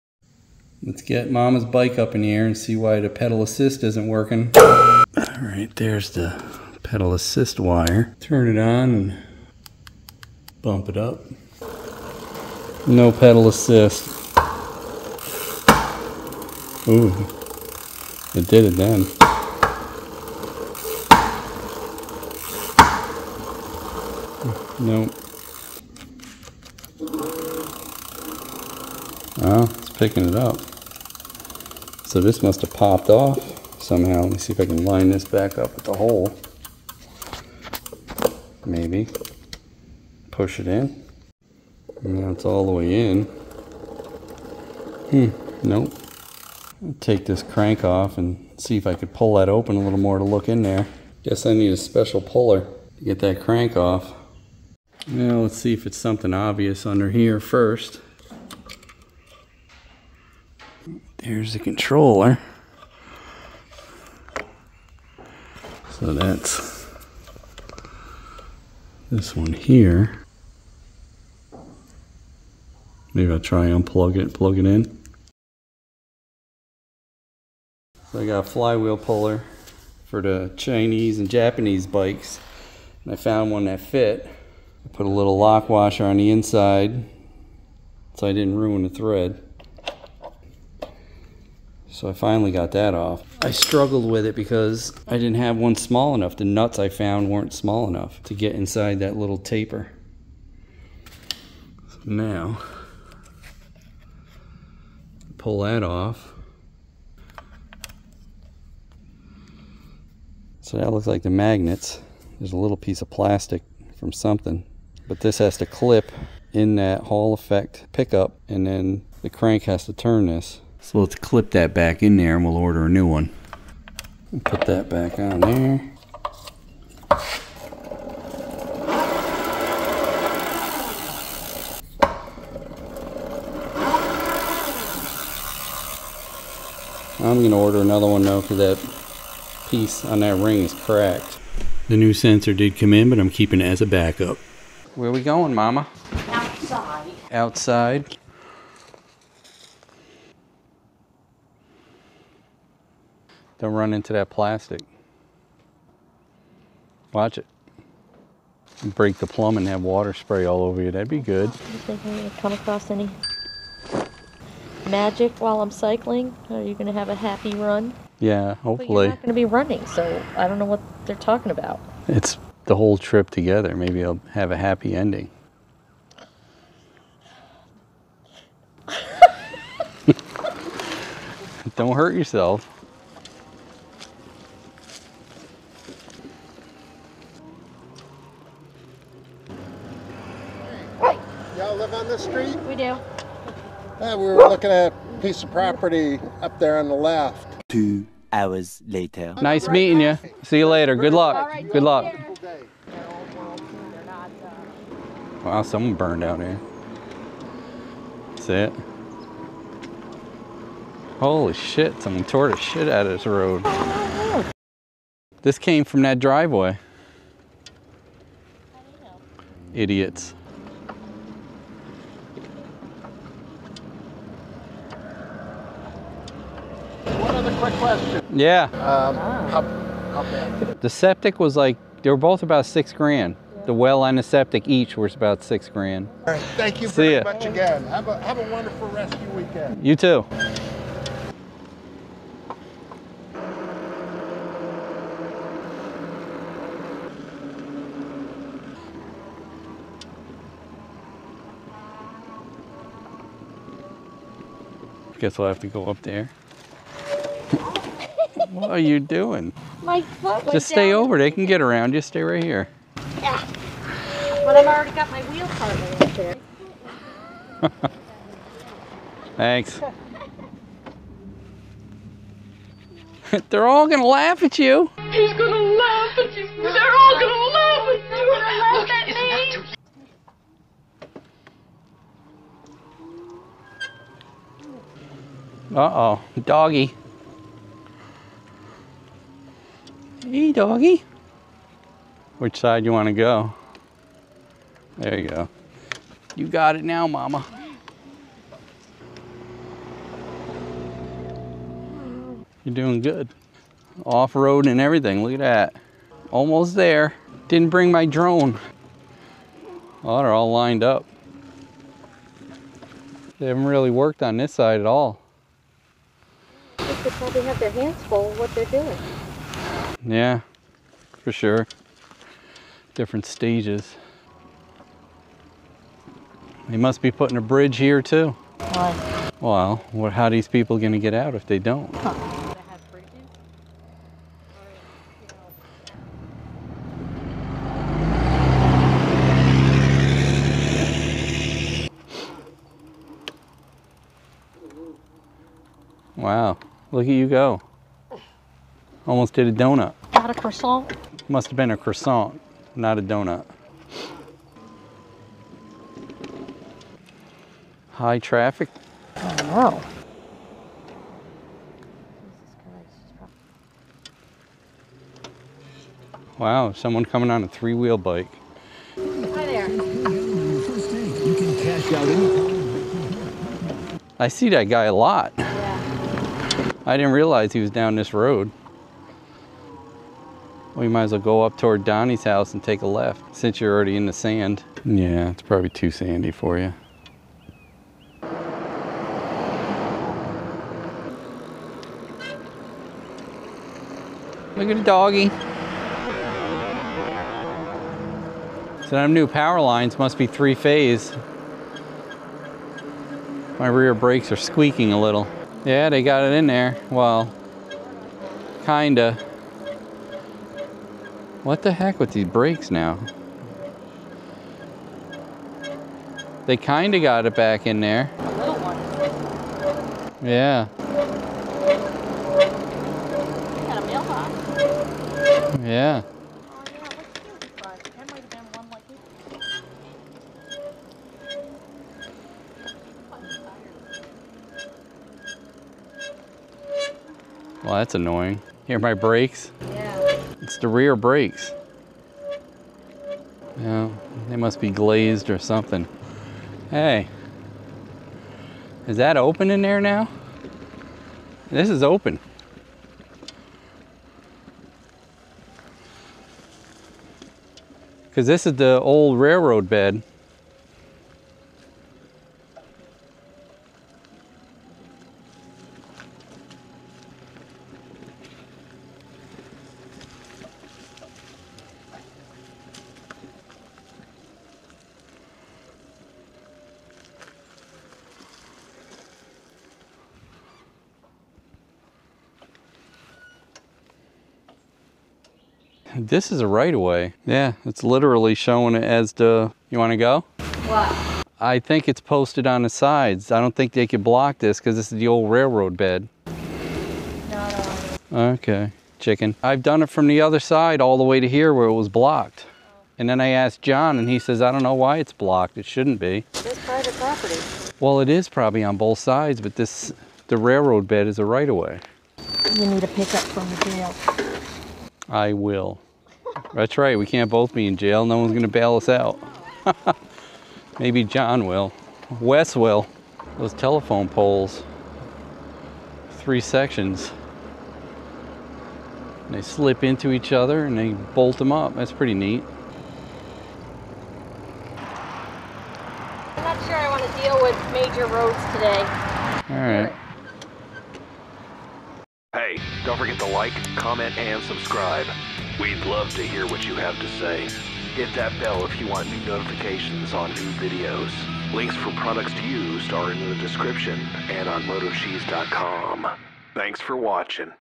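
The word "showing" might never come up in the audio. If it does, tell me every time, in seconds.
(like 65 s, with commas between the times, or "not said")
488 s.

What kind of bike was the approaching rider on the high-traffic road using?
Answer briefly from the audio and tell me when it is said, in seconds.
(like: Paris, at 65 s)
Three-wheel bike, at 367 s.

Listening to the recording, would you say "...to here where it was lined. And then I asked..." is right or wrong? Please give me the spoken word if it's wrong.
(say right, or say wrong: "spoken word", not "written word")
wrong: "blocked", not "lined".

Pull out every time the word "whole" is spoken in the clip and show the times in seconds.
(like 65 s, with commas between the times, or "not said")
172 s.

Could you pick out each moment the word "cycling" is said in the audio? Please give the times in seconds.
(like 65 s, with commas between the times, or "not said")
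165 s.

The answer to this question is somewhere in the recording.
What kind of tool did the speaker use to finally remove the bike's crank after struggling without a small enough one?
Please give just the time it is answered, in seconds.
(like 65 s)
78 s.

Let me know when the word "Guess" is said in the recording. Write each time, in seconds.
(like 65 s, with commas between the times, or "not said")
51 s, 255 s.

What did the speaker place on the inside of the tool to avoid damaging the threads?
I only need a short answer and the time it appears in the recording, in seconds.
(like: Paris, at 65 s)
Lock washer, at 85 s.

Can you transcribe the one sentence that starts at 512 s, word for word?
You need a pickup from the jail.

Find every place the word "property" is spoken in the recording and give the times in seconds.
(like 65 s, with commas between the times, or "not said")
195 s, 506 s.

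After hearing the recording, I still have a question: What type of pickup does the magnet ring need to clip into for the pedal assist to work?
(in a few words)
Hall effect pickup.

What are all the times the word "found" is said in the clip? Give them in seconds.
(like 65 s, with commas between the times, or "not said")
83 s, 96 s.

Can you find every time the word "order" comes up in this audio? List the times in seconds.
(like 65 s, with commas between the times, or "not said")
122 s, 137 s.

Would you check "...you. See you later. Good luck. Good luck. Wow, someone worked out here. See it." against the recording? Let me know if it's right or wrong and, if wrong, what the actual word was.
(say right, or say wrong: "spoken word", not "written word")
wrong: "burned", not "worked".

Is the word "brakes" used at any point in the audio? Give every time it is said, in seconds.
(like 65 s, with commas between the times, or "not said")
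403 s, 440 s.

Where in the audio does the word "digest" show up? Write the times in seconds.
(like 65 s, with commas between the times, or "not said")
not said.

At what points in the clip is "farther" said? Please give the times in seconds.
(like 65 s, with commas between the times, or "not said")
not said.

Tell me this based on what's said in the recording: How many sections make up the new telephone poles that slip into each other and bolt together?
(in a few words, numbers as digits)
3.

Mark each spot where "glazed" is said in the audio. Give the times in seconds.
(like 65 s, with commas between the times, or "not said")
444 s.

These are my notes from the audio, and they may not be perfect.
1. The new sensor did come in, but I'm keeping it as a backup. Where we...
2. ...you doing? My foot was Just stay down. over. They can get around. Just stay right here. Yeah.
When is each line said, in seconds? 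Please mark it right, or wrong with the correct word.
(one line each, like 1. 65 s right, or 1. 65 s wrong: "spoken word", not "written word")
1. 141 s right
2. 258 s right.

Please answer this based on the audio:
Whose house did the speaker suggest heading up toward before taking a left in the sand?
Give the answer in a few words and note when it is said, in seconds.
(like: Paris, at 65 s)
Donnie's, at 381 s.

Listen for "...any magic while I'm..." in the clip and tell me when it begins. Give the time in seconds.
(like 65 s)
162 s.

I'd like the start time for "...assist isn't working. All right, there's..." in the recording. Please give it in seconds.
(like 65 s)
3 s.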